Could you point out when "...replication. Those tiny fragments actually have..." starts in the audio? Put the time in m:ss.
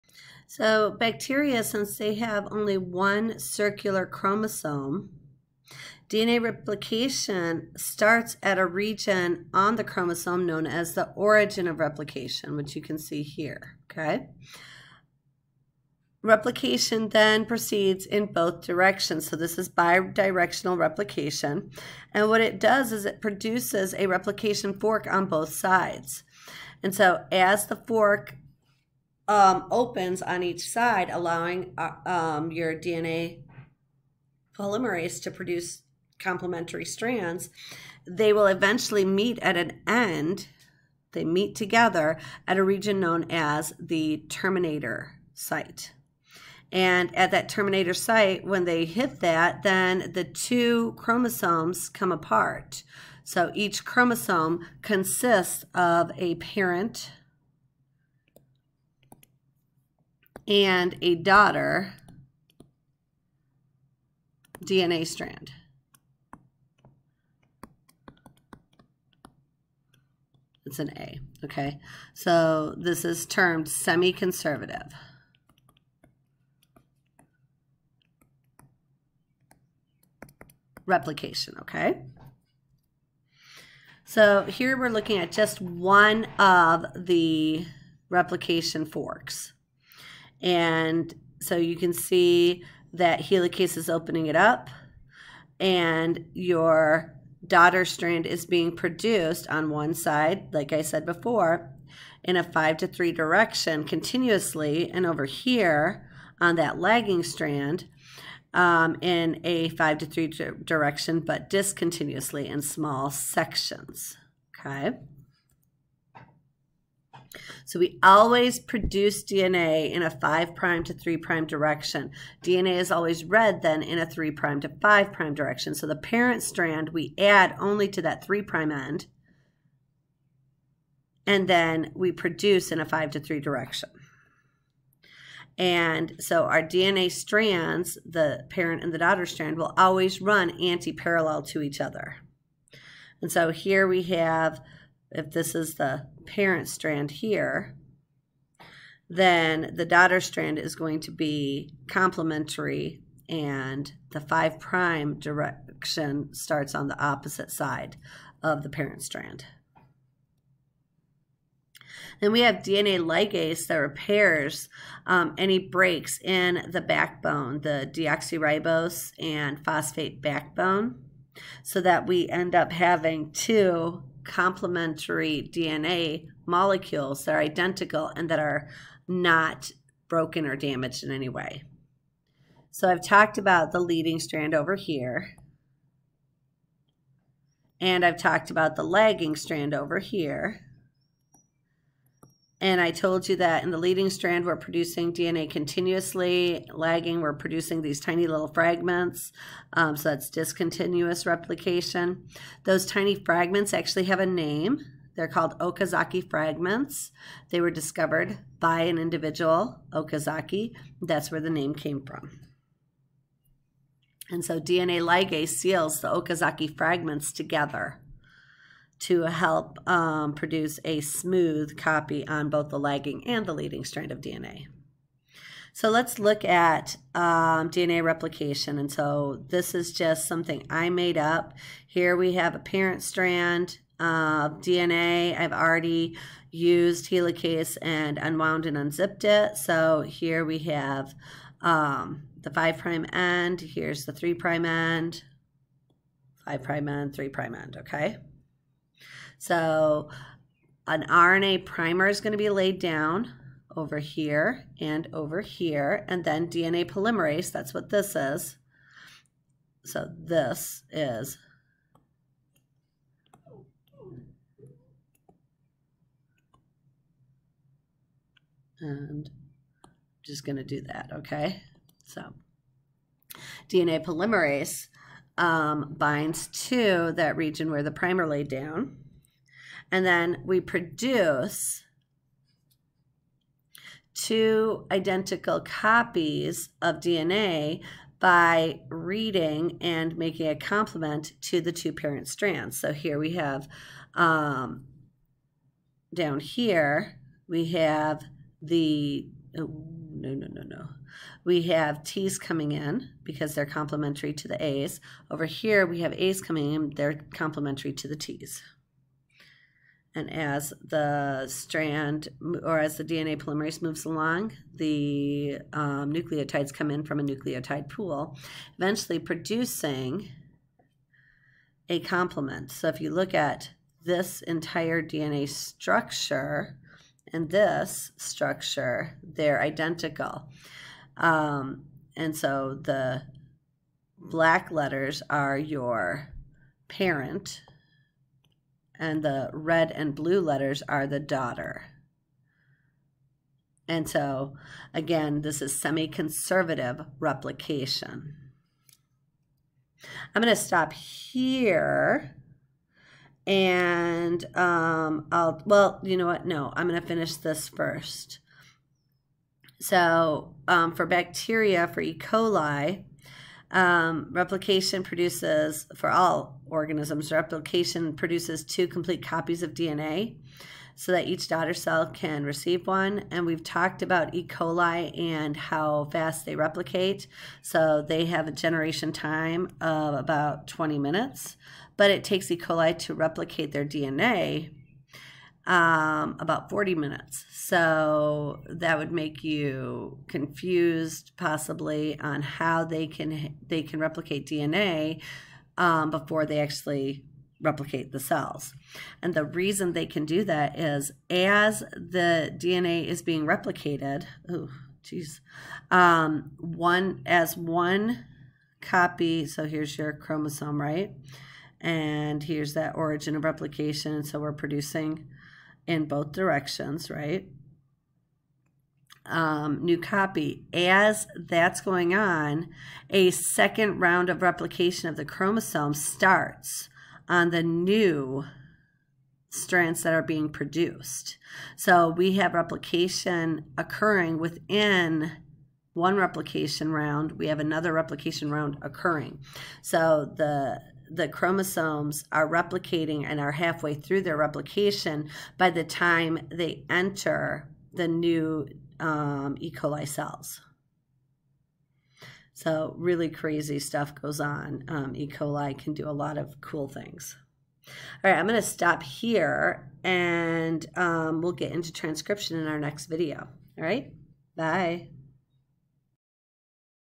3:21.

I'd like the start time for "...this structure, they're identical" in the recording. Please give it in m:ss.
5:27.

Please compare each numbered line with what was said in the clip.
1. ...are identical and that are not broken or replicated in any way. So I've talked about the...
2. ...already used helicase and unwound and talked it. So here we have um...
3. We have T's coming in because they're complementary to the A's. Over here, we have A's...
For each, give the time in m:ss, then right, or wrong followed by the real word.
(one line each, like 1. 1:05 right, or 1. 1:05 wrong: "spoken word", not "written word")
1. 2:57 wrong: "damaged", not "replicated"
2. 3:55 wrong: "unzipped", not "talked"
3. 5:01 right.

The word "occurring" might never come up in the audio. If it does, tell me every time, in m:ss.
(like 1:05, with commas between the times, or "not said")
7:13, 7:18.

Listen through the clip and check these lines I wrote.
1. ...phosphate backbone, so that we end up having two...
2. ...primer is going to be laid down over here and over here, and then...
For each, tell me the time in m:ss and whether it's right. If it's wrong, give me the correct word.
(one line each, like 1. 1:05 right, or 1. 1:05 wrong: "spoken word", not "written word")
1. 2:49 right
2. 4:11 right.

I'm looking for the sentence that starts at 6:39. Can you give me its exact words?
And the reason they can do that is as the DNA is being replicated, oh, geez, um, one as one copy.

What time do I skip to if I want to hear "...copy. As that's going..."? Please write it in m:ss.
6:59.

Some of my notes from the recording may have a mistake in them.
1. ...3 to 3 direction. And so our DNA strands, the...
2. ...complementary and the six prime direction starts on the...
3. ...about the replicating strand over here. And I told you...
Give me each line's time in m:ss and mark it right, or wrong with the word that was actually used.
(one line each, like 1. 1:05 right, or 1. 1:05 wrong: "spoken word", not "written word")
1. 2:12 wrong: "5", not "3"
2. 2:31 wrong: "five", not "six"
3. 3:08 wrong: "lagging", not "replicating".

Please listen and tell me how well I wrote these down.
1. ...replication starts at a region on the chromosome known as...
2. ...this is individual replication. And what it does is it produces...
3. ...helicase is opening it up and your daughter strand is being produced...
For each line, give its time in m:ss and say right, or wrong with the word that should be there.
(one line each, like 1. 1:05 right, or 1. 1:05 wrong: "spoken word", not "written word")
1. 0:06 right
2. 0:19 wrong: "bidirectional", not "individual"
3. 1:33 right.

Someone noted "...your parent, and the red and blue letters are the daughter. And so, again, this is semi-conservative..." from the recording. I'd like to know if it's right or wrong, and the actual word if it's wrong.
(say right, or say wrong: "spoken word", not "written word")
right.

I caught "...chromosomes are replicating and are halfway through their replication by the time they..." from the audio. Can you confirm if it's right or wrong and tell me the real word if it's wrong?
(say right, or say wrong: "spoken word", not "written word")
right.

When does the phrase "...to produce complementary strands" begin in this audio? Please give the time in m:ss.
0:35.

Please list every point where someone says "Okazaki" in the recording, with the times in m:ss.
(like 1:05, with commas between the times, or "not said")
3:25, 3:29, 3:36.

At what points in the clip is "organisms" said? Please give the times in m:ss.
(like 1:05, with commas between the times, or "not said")
6:06.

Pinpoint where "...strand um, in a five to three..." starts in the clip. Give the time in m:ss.
1:47.